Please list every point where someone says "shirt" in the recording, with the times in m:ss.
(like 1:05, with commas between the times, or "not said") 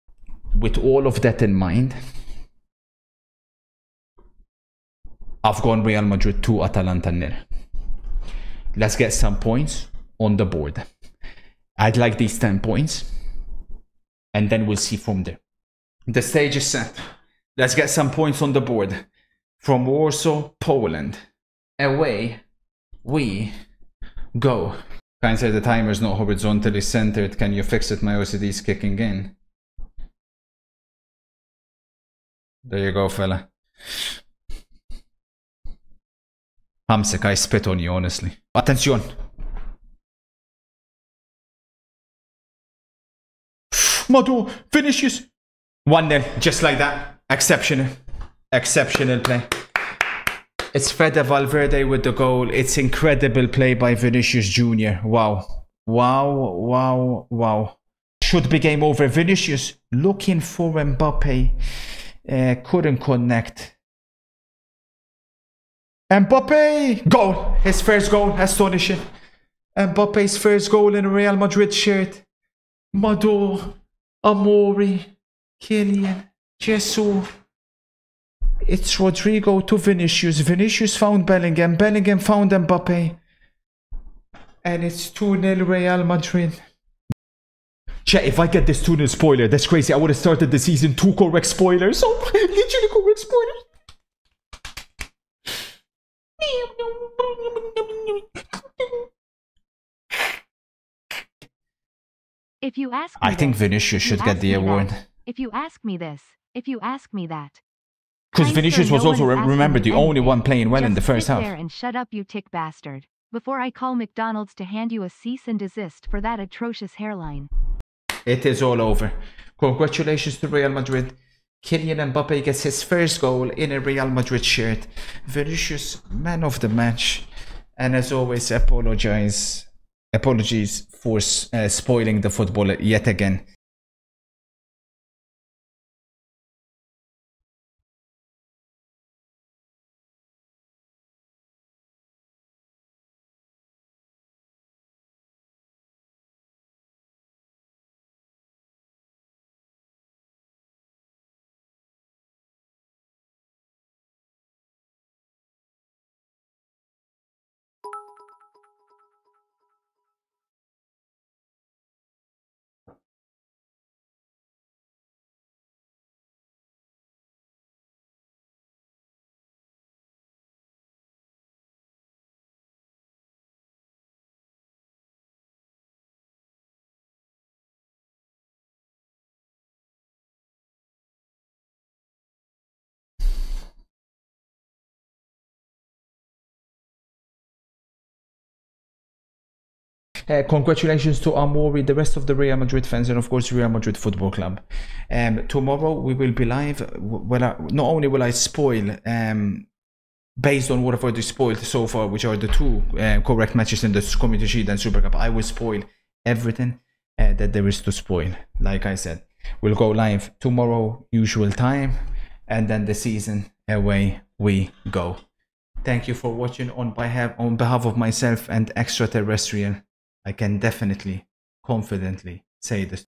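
1:11, 2:04.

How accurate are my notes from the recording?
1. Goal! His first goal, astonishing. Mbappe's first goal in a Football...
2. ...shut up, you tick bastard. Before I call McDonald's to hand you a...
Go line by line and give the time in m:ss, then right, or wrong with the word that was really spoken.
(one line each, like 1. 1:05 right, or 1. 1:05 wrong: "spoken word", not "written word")
1. 1:07 wrong: "Real", not "Football"
2. 1:51 right.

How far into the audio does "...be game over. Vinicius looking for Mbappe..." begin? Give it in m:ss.
0:58.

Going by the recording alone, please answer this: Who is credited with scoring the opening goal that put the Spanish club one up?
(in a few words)
Fede Valverde.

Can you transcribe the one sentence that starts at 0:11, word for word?
I'd like these 10 points, and then we'll see from there.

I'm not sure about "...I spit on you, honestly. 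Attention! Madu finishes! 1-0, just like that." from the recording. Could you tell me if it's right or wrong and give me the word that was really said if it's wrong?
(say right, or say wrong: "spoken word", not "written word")
right.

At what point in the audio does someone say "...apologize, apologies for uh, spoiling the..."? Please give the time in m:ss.
2:08.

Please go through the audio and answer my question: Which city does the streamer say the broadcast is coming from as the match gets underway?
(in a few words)
Warsaw.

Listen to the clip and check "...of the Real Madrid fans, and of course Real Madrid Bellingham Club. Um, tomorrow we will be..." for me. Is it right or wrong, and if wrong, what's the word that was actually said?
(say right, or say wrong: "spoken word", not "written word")
wrong: "Football", not "Bellingham".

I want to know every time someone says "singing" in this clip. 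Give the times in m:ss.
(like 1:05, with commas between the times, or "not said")
not said.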